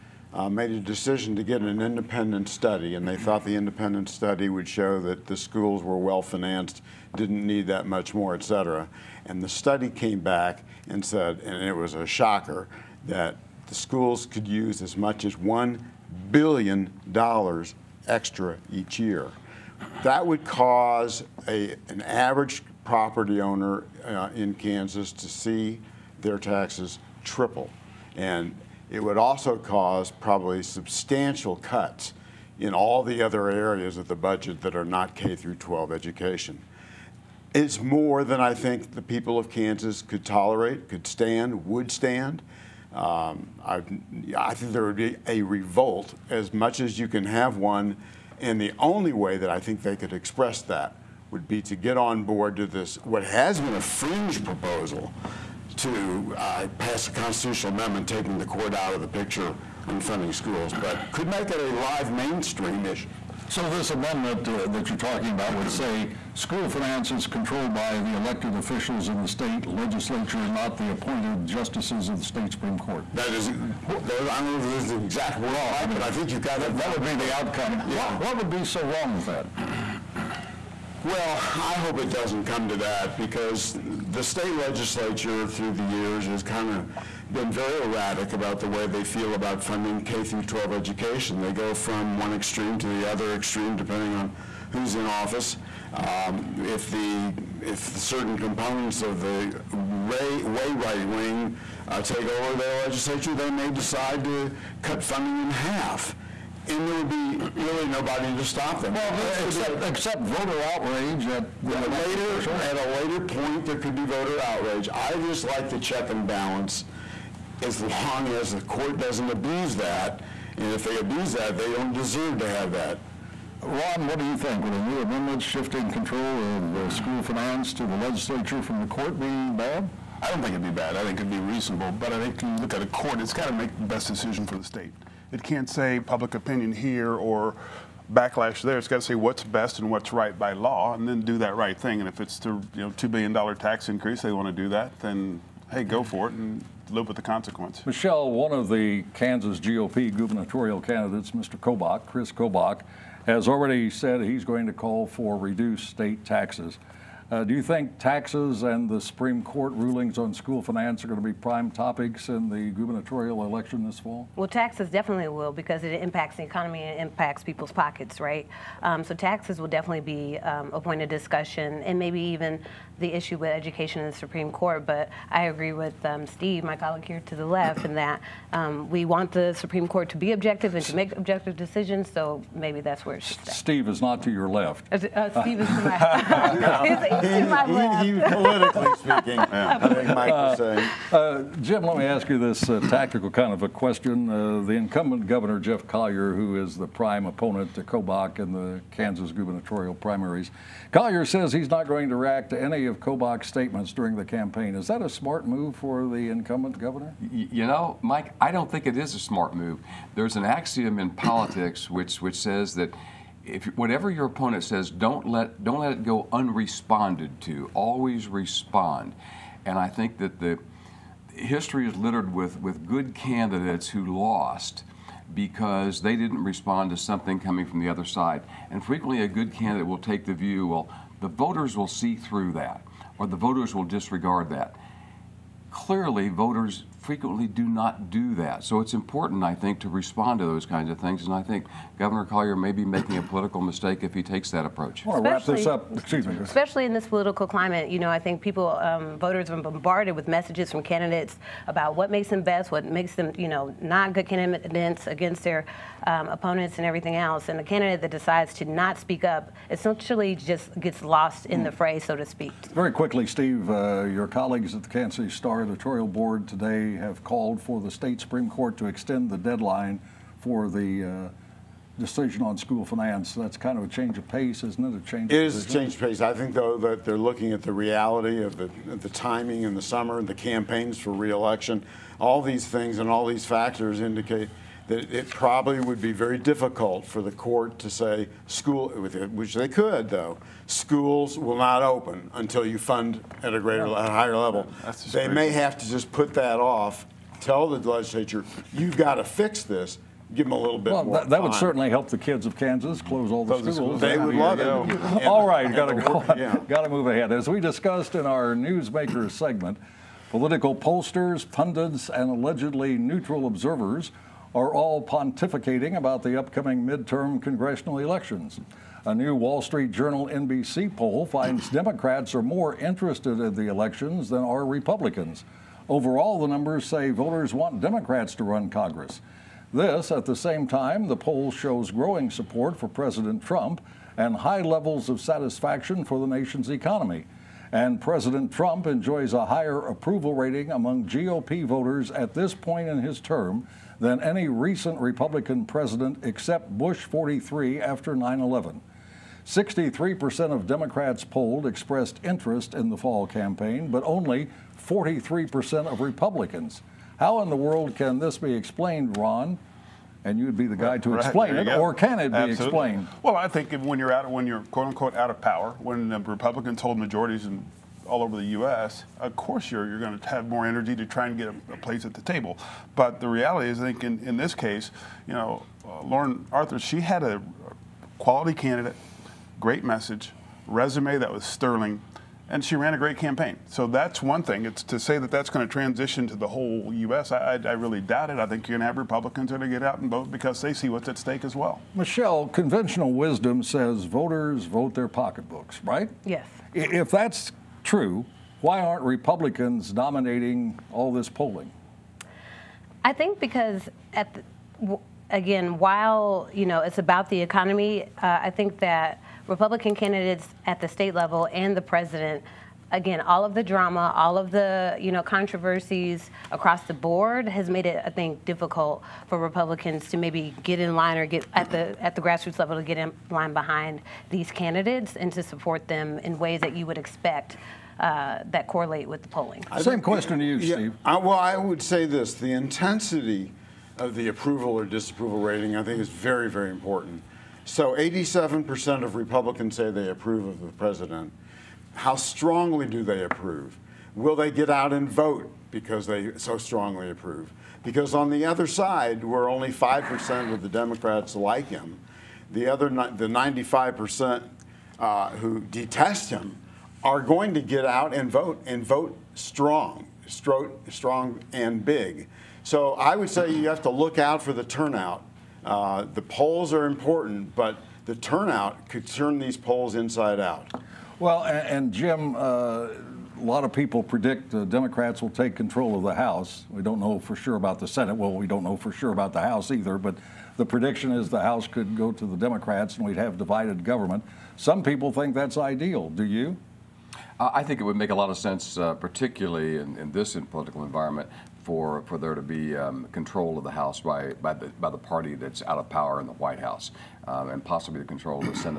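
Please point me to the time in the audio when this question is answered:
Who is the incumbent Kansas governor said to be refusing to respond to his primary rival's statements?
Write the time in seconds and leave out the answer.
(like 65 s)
195 s.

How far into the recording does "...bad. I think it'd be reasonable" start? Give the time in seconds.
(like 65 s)
130 s.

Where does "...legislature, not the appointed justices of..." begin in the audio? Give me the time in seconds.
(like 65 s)
69 s.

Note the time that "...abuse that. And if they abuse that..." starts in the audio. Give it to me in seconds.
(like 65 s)
119 s.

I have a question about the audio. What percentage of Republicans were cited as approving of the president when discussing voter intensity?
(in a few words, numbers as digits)
87%.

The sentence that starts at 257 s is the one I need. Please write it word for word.
And a candidate that decides to not speak up essentially just gets lost in mm.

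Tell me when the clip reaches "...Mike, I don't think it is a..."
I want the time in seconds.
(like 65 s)
208 s.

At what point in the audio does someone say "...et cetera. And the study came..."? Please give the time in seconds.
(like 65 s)
8 s.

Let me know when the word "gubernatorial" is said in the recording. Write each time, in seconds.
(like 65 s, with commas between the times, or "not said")
150 s, 162 s, 199 s.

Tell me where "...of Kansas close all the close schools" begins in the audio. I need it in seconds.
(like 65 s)
302 s.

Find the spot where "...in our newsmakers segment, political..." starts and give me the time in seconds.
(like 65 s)
308 s.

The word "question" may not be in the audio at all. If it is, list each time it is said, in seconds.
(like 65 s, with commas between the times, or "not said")
193 s, 430 s.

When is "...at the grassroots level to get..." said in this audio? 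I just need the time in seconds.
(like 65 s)
422 s.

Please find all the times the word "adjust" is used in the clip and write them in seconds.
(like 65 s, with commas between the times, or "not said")
not said.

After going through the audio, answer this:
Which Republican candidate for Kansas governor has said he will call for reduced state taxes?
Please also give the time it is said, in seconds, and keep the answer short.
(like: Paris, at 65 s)
Kris Kobach, at 152 s.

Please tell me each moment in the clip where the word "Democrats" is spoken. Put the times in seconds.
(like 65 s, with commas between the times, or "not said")
321 s, 327 s, 350 s, 450 s, 474 s, 482 s.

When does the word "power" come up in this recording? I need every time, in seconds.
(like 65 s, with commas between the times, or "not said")
365 s, 495 s.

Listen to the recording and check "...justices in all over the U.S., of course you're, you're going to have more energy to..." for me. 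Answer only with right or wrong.
wrong.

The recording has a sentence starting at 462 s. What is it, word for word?
So I would say you have to look out for the turnout.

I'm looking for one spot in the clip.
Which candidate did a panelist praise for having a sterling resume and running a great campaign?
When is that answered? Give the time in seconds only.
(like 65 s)
376 s.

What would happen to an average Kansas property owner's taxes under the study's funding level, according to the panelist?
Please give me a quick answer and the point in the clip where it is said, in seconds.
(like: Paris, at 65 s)
triple, at 27 s.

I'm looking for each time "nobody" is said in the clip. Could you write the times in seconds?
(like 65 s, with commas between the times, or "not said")
107 s.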